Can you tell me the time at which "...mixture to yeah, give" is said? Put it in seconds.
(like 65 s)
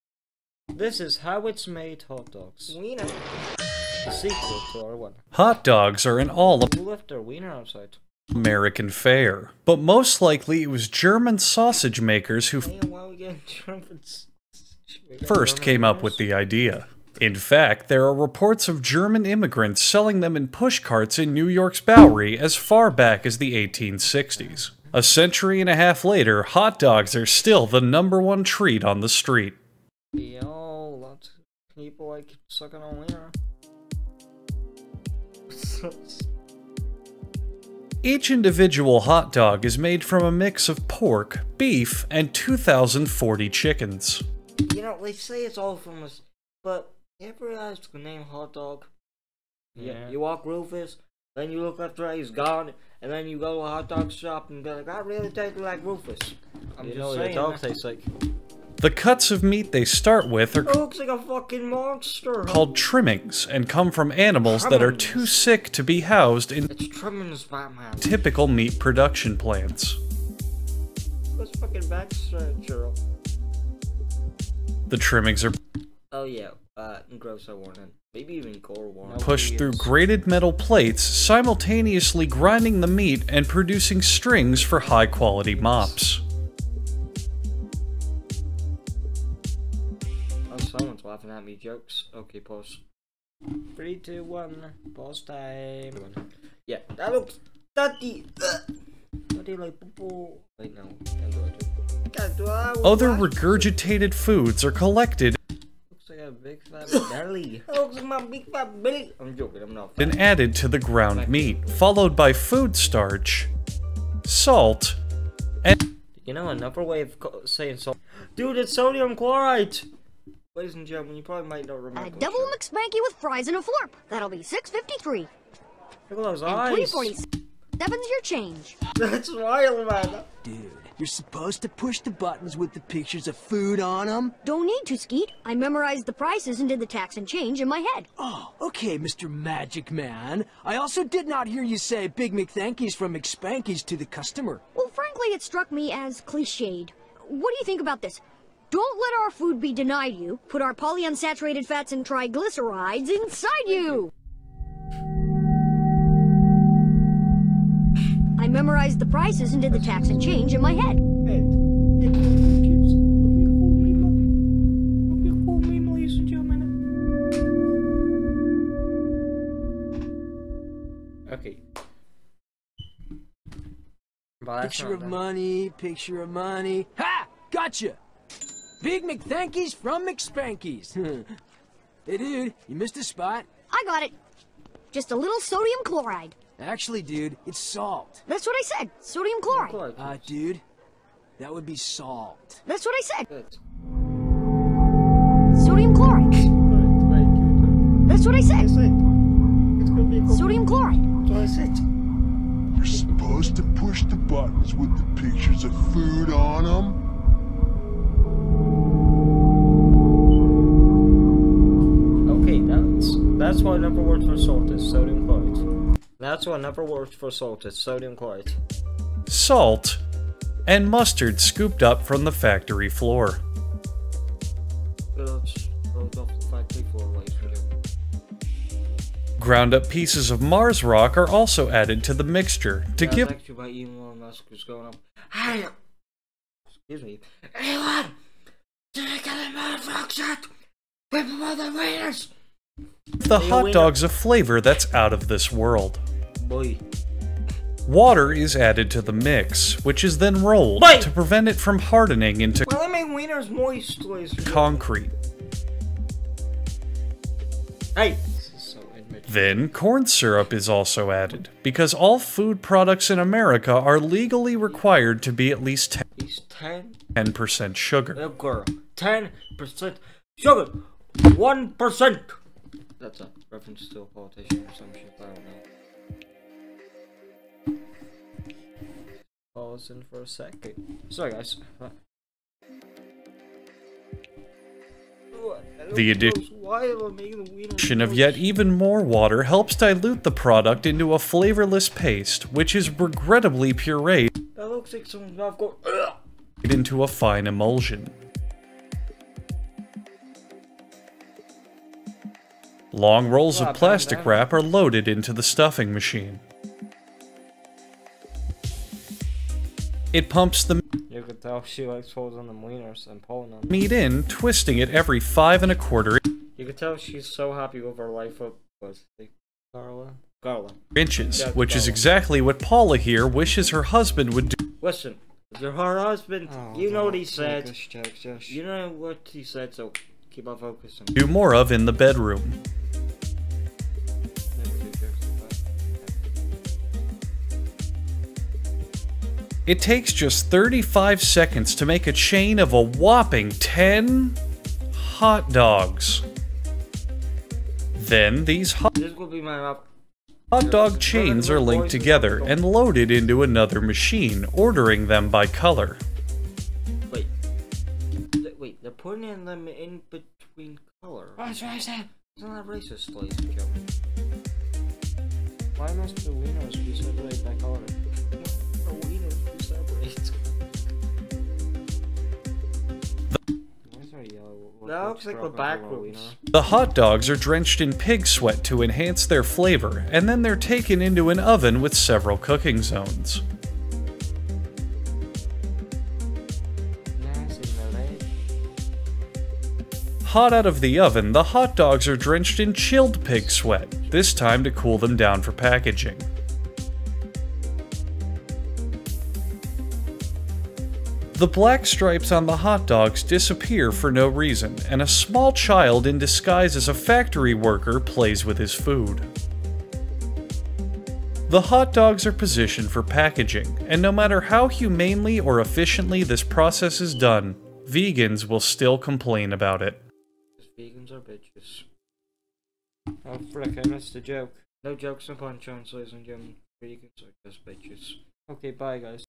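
232 s.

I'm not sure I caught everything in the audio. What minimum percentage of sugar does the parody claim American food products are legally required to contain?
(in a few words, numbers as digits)
10%.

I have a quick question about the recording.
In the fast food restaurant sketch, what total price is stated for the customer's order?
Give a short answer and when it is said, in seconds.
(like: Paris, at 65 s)
6.53, at 124 s.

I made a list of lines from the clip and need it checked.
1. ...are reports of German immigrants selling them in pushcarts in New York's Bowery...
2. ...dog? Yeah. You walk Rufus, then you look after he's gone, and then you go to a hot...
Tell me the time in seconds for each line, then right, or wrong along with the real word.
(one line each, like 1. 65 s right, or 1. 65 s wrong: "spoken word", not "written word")
1. 18 s right
2. 48 s right.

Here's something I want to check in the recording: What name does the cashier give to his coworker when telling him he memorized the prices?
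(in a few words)
Skeet.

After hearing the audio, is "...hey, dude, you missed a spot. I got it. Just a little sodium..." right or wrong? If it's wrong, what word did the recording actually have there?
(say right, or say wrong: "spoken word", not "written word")
right.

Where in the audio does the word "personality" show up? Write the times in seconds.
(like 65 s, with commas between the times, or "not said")
not said.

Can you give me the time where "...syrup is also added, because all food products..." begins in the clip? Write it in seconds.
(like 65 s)
260 s.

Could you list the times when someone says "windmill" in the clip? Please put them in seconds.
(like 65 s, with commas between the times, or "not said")
not said.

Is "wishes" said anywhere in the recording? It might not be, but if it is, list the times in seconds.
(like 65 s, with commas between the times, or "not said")
323 s.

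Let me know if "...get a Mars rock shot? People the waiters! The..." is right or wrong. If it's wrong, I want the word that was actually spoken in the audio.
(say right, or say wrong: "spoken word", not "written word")
right.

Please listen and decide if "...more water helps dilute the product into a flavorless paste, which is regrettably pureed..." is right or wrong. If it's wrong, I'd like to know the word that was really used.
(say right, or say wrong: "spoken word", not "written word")
right.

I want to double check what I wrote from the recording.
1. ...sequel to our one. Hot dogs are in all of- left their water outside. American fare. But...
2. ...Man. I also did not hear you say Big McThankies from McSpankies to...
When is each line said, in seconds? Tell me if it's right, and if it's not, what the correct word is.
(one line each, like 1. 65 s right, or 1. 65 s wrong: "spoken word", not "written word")
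1. 4 s wrong: "wiener", not "water"
2. 139 s right.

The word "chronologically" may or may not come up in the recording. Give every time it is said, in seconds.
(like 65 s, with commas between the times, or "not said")
not said.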